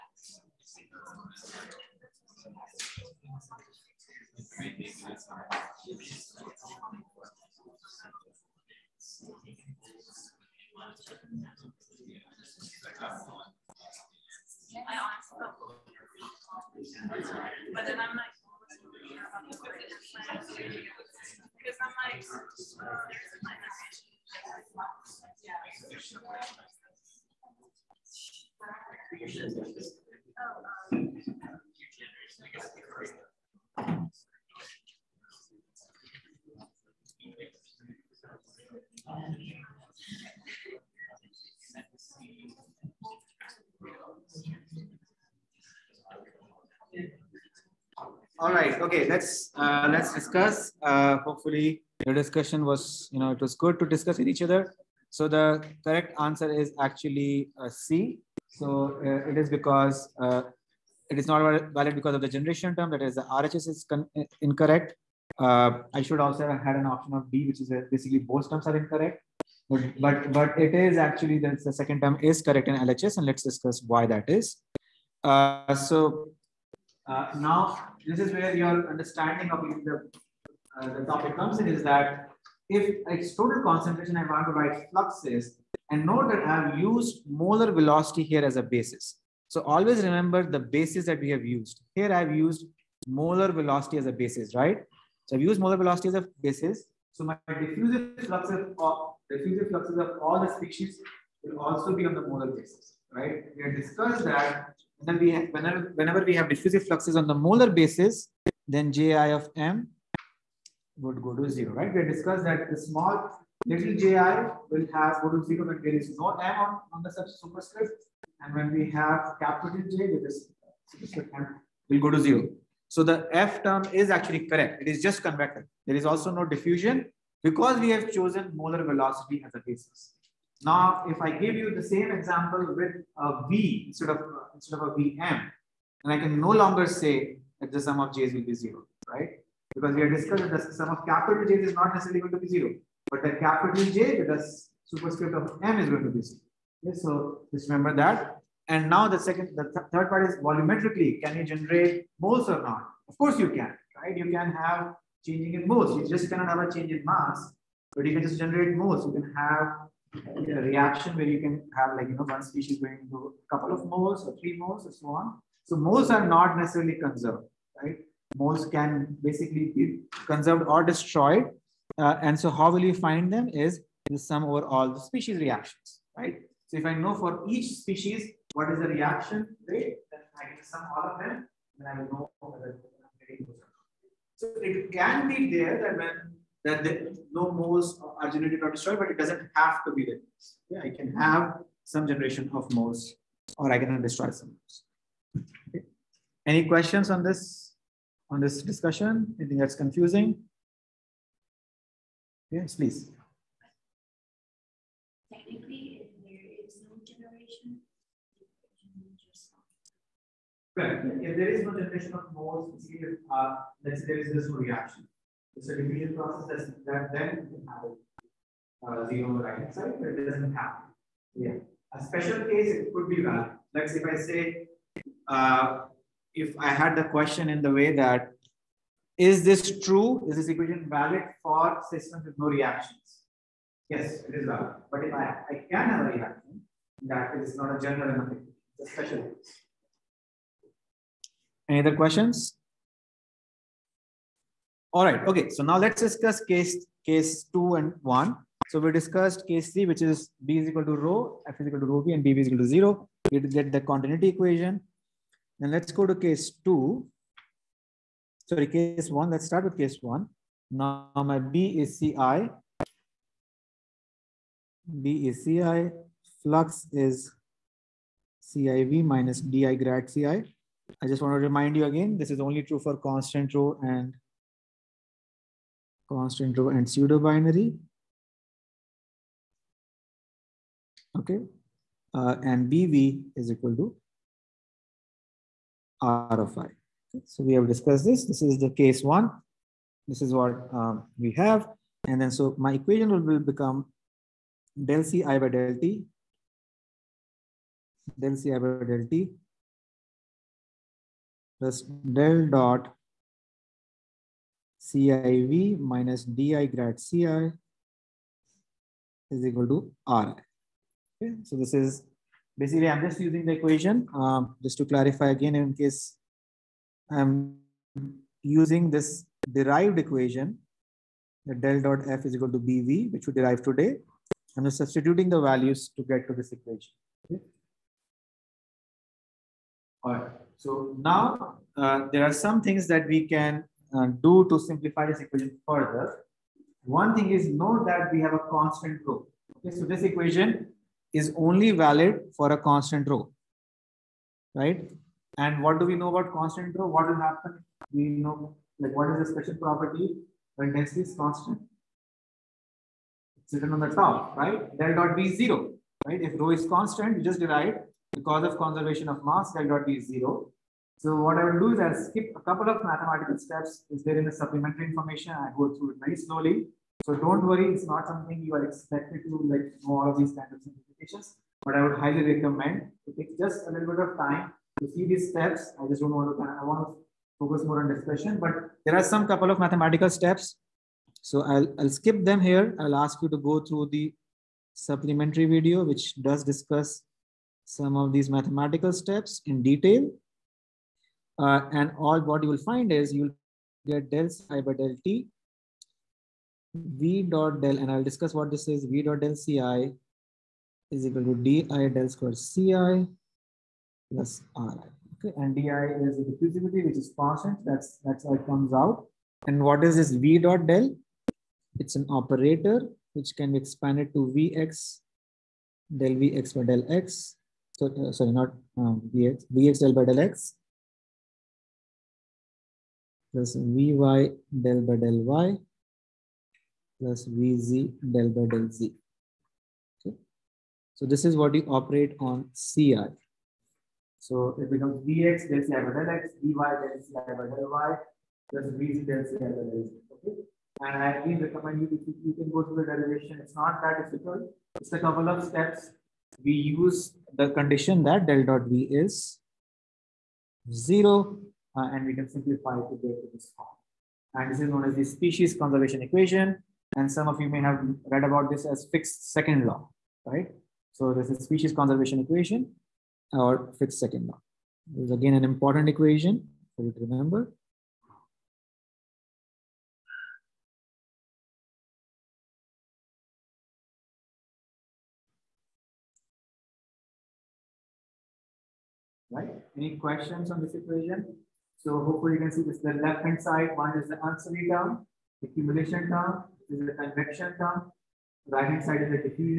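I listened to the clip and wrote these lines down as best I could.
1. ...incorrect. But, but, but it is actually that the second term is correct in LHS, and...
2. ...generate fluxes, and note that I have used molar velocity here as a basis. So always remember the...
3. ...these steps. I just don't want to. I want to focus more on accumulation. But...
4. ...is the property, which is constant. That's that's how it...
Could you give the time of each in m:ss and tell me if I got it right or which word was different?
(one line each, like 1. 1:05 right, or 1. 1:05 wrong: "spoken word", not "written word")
1. 1:08 right
2. 1:24 wrong: "write", not "generate"
3. 6:15 wrong: "discussion", not "accumulation"
4. 6:45 wrong: "diffusivity", not "property".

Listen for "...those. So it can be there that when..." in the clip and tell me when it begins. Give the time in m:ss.
3:03.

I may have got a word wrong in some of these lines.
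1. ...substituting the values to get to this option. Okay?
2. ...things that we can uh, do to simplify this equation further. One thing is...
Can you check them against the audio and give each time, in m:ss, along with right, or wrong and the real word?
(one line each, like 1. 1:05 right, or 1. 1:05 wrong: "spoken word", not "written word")
1. 5:24 wrong: "equation", not "option"
2. 5:32 right.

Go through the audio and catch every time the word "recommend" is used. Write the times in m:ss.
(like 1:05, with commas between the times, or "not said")
6:12, 7:21.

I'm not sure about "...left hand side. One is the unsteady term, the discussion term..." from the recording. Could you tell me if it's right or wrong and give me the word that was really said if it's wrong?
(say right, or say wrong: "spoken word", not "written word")
wrong: "accumulation", not "discussion".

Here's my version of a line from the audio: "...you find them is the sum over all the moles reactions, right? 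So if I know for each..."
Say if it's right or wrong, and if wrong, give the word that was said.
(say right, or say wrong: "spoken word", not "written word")
wrong: "species", not "moles".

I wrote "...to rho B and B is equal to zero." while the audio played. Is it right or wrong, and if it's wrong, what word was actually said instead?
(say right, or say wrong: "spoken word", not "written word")
right.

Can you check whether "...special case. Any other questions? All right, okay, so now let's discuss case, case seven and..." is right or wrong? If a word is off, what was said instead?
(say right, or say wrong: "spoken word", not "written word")
wrong: "two", not "seven".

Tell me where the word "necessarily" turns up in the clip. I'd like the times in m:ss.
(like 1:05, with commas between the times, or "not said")
2:21, 2:46.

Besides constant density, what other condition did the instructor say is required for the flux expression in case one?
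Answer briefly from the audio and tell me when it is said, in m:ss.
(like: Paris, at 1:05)
Pseudo binary, at 4:36.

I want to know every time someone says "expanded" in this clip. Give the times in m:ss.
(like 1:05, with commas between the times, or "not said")
6:53.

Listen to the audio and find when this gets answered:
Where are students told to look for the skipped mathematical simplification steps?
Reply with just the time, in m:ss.
6:24.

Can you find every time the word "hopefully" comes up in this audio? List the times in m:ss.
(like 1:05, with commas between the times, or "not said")
0:51, 8:02.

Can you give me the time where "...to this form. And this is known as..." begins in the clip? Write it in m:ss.
7:33.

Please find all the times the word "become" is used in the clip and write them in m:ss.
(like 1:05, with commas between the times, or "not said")
4:53, 7:14.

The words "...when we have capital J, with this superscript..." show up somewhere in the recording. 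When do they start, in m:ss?
1:58.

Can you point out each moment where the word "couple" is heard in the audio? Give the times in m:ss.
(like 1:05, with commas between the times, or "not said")
2:43, 6:02, 6:19, 7:24.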